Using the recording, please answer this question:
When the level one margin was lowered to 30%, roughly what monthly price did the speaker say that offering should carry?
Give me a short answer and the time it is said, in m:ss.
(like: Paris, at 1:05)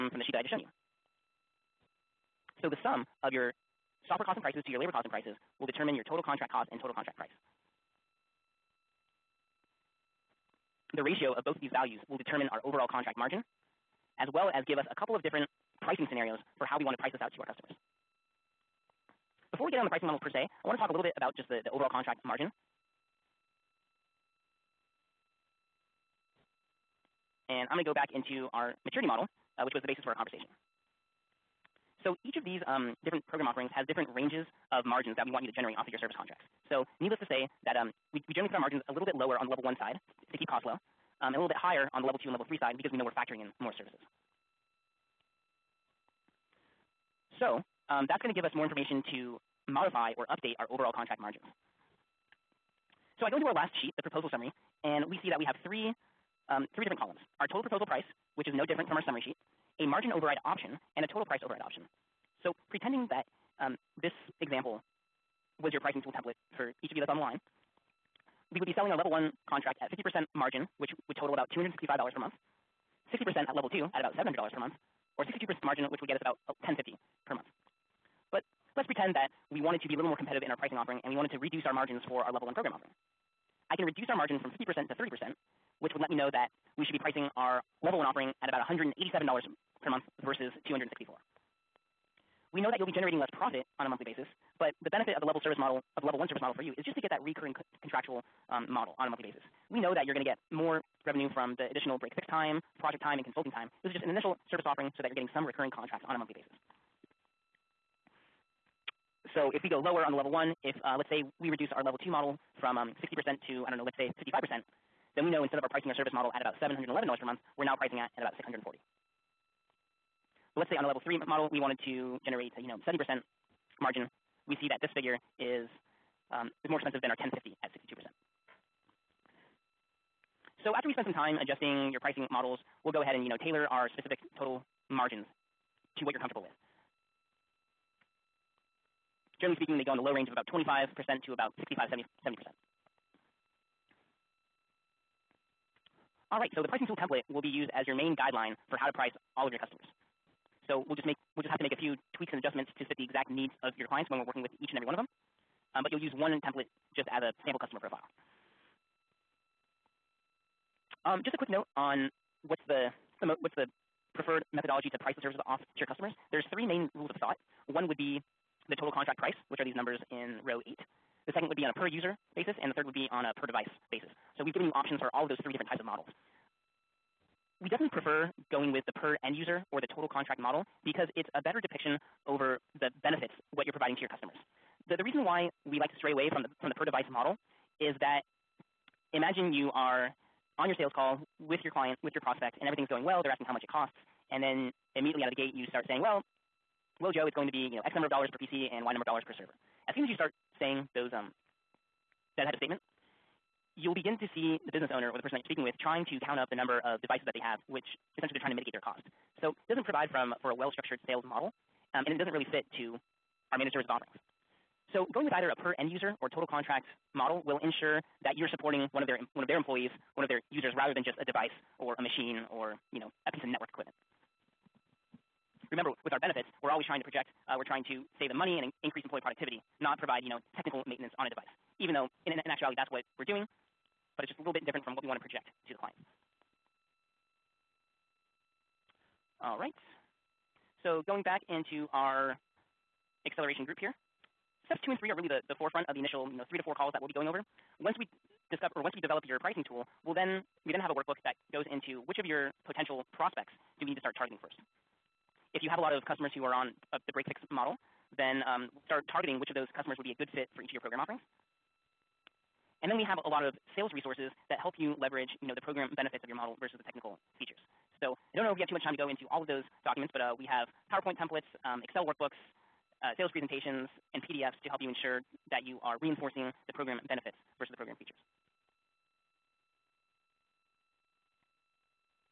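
$187, at 1:28.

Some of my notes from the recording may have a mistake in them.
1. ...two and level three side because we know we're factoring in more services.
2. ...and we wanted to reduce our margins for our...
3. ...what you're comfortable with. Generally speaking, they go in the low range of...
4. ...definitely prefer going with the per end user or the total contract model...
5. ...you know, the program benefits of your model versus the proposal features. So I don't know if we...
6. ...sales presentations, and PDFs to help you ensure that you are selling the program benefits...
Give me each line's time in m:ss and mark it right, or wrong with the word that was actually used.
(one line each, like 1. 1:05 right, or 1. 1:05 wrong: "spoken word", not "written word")
1. 0:42 right
2. 1:21 right
3. 2:16 right
4. 2:57 right
5. 4:25 wrong: "technical", not "proposal"
6. 4:33 wrong: "reinforcing", not "selling".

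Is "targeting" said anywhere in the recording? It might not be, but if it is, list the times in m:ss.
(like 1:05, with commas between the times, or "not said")
4:14, 4:19.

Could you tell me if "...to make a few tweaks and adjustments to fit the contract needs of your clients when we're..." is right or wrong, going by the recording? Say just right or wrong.
wrong.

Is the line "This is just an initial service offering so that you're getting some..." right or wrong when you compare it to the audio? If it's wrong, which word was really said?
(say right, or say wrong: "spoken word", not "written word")
right.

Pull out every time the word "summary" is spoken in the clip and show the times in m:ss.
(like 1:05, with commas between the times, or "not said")
0:54, 0:59.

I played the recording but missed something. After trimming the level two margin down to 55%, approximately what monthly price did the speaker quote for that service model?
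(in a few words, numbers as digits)
640.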